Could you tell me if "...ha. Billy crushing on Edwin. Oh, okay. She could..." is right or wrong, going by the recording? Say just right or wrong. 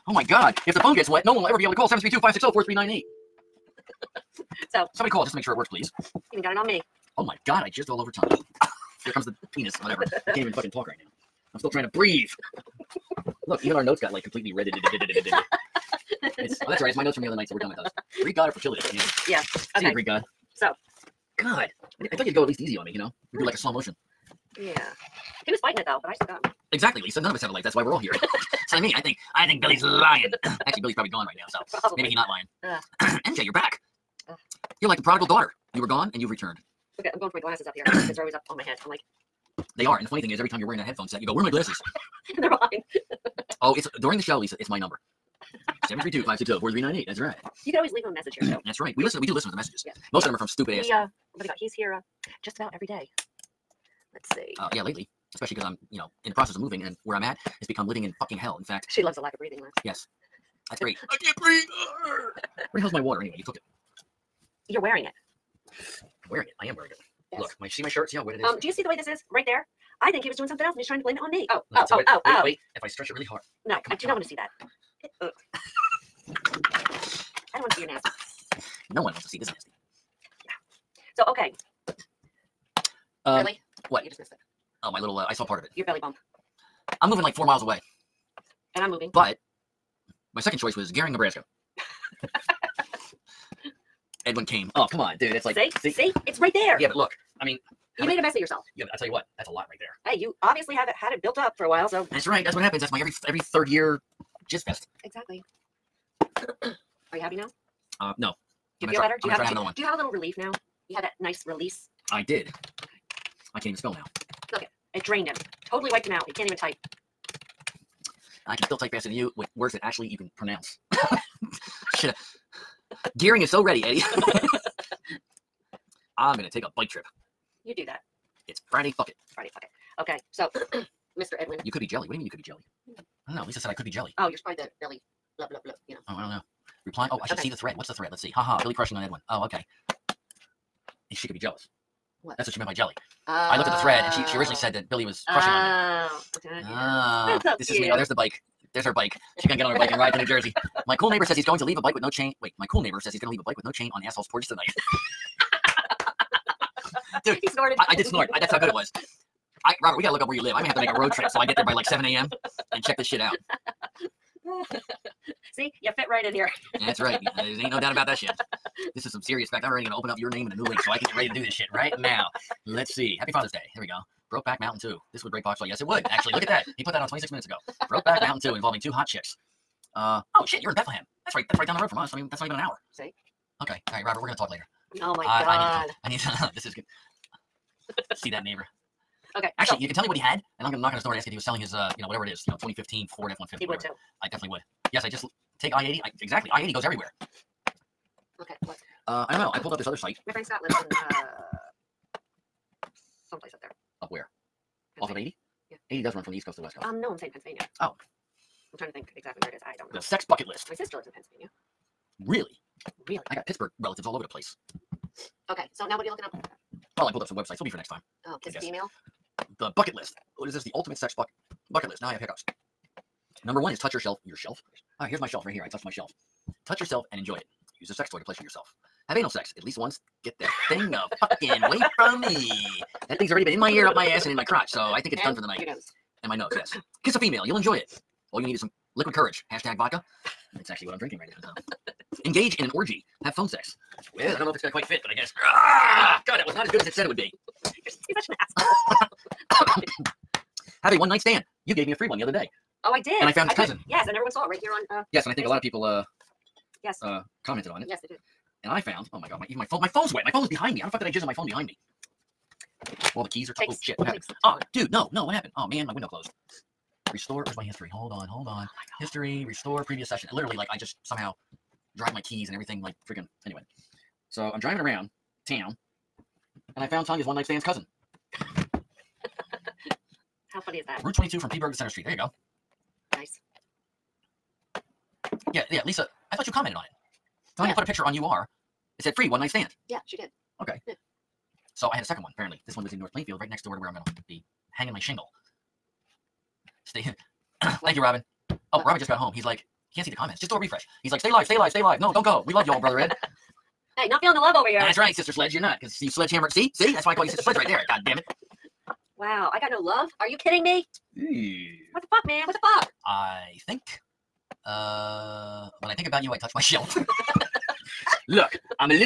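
right.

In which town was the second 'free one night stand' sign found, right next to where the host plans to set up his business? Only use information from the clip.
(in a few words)
North Plainfield.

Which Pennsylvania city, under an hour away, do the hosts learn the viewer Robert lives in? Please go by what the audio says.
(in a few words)
Bethlehem.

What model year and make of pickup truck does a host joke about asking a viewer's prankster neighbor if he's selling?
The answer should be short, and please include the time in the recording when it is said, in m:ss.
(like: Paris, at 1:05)
2015 Ford F-150, at 3:12.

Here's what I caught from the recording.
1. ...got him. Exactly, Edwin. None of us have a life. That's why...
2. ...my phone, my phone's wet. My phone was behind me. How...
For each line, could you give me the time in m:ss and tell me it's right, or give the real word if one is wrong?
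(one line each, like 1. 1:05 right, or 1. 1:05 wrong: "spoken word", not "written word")
1. 0:26 wrong: "Lisa", not "Edwin"
2. 4:19 right.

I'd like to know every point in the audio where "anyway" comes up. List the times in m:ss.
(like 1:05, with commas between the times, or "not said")
1:03, 4:33.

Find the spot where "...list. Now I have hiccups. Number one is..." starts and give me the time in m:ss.
3:41.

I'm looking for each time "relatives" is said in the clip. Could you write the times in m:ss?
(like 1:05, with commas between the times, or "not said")
3:33.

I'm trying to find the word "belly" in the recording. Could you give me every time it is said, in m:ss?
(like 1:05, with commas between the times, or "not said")
1:25, 2:14.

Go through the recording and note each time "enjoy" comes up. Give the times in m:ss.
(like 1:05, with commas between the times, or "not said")
3:47, 3:57.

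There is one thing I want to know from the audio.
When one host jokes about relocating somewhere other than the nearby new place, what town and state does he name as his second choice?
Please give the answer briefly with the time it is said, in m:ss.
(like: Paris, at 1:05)
Gering, Nebraska, at 1:30.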